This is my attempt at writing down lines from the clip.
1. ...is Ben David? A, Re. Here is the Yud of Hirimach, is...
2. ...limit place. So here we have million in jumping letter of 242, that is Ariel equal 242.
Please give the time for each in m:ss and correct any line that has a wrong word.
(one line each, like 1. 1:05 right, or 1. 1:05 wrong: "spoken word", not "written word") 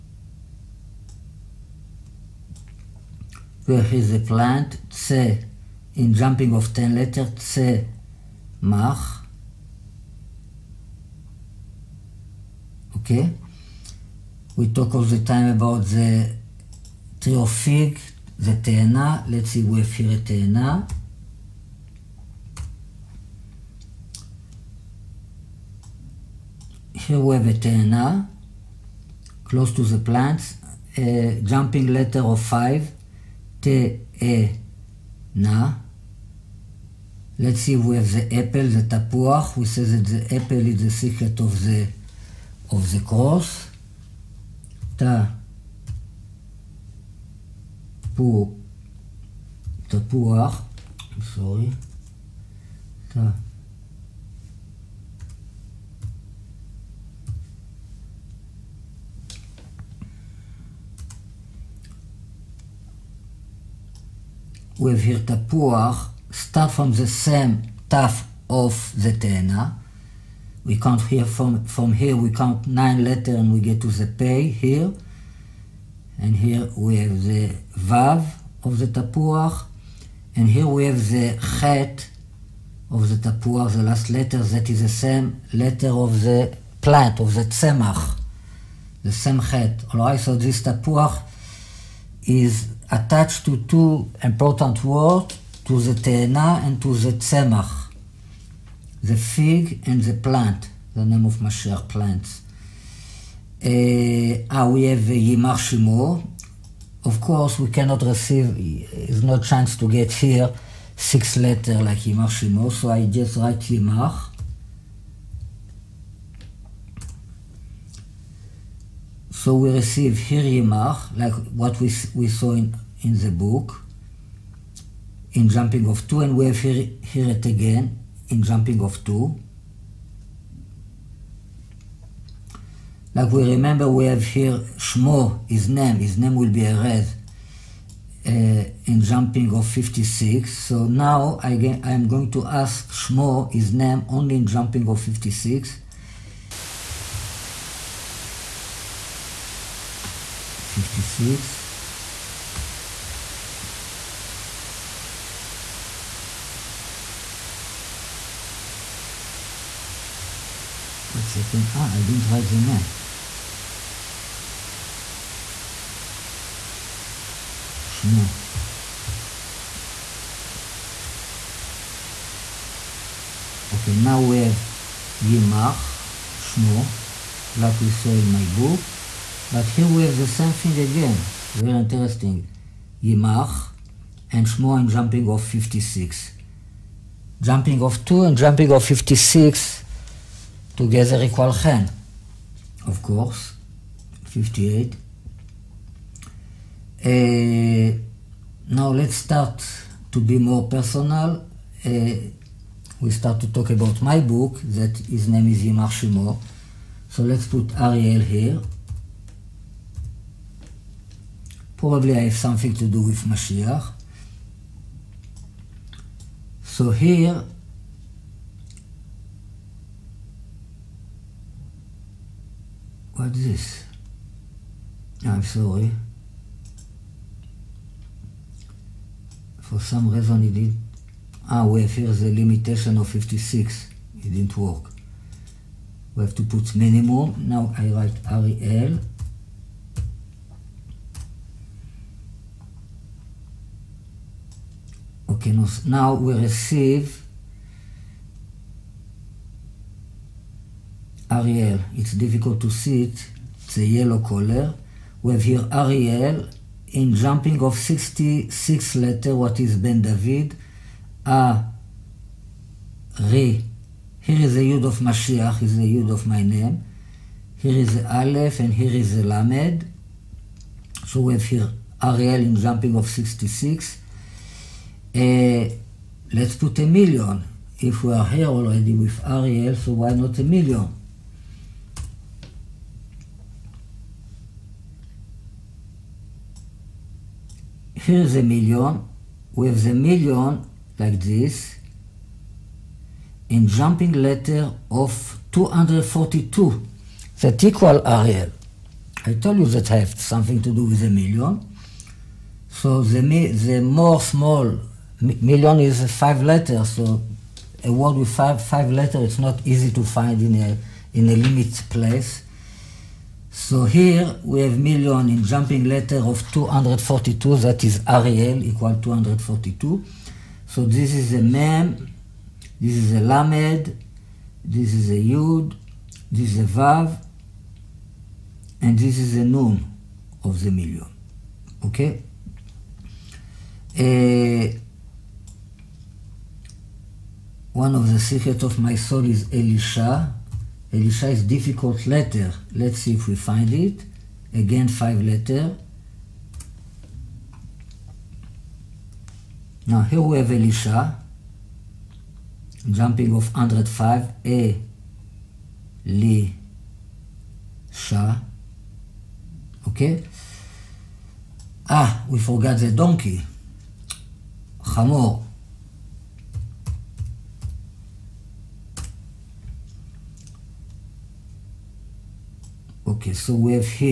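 1. 4:19 wrong: "Mashiach", not "Hirimach"
2. 5:11 right.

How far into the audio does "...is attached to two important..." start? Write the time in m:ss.
1:32.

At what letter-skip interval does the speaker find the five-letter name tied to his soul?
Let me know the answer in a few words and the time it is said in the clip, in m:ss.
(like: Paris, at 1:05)
105, at 5:52.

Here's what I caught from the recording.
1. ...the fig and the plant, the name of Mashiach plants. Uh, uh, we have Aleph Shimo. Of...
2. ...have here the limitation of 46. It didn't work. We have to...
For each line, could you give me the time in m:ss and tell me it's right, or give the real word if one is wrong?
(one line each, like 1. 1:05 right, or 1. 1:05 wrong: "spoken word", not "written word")
1. 1:39 wrong: "Yimach", not "Aleph"
2. 3:51 wrong: "56", not "46".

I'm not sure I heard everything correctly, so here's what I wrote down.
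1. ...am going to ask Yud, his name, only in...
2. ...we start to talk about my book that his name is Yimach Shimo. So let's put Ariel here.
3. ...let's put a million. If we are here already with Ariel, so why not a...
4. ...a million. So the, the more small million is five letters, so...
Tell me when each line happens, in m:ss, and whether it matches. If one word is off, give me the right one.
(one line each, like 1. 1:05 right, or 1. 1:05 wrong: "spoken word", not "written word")
1. 2:21 wrong: "Shmo", not "Yud"
2. 3:22 right
3. 4:36 right
4. 5:01 right.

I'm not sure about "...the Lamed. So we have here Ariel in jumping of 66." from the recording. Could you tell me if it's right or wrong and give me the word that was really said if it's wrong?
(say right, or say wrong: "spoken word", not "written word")
right.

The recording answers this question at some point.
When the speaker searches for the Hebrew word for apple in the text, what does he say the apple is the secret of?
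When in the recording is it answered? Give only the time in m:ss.
0:40.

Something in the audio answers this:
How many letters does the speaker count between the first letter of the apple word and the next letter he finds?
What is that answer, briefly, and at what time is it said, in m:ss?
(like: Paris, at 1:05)
9, at 1:12.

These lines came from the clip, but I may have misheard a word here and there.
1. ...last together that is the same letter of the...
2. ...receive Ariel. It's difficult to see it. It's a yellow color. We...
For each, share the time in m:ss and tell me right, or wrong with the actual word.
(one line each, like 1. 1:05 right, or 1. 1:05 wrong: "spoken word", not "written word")
1. 1:23 wrong: "letter", not "together"
2. 4:06 right.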